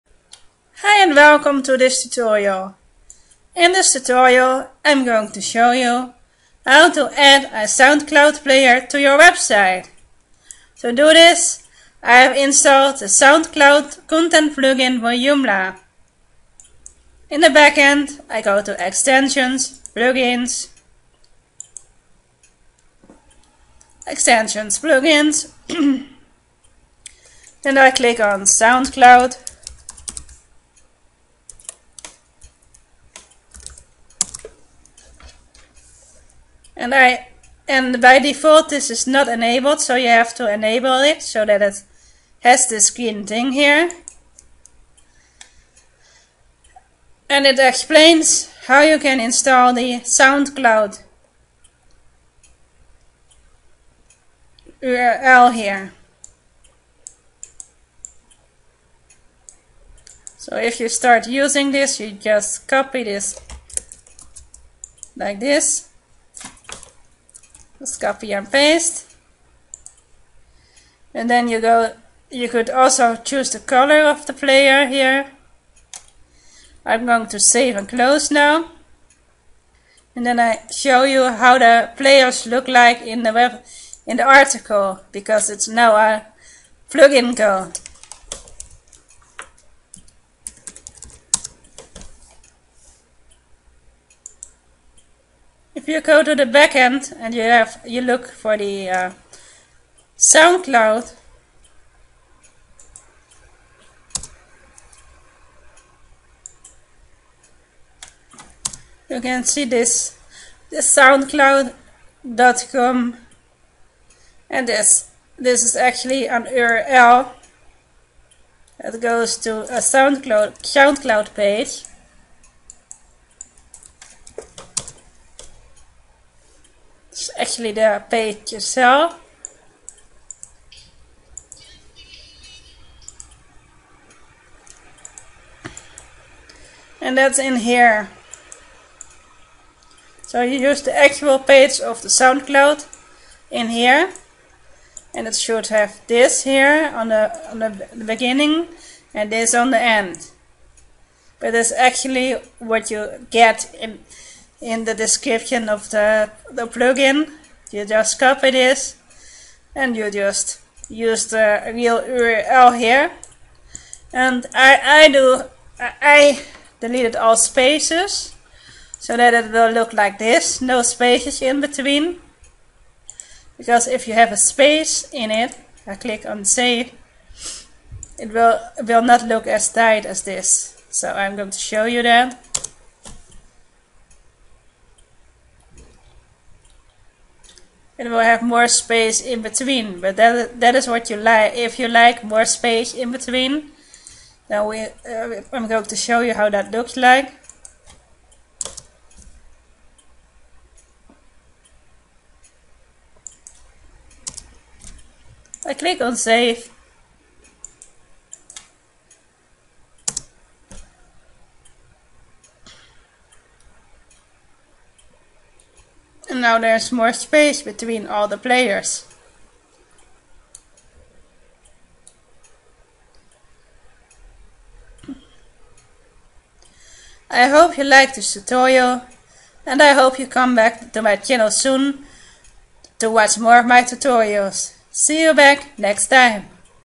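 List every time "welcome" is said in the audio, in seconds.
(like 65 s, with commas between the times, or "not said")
1 s.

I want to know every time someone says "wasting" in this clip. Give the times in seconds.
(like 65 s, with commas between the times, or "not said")
not said.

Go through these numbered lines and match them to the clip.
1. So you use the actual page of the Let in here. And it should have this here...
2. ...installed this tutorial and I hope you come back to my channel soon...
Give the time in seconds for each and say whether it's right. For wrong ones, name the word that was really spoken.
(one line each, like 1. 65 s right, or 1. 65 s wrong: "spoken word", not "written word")
1. 140 s wrong: "SoundCloud", not "Let"
2. 227 s wrong: "liked", not "installed".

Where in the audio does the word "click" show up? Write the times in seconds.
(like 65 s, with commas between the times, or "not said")
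27 s, 175 s, 205 s.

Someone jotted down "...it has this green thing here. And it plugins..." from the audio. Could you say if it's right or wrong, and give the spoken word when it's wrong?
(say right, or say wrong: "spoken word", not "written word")
wrong: "explains", not "plugins".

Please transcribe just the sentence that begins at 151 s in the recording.
But that's actually what you get in in the description of the, the plugin.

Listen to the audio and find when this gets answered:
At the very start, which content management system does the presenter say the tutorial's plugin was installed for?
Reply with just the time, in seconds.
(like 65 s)
15 s.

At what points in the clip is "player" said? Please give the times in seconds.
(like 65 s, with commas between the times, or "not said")
8 s, 74 s, 81 s, 218 s.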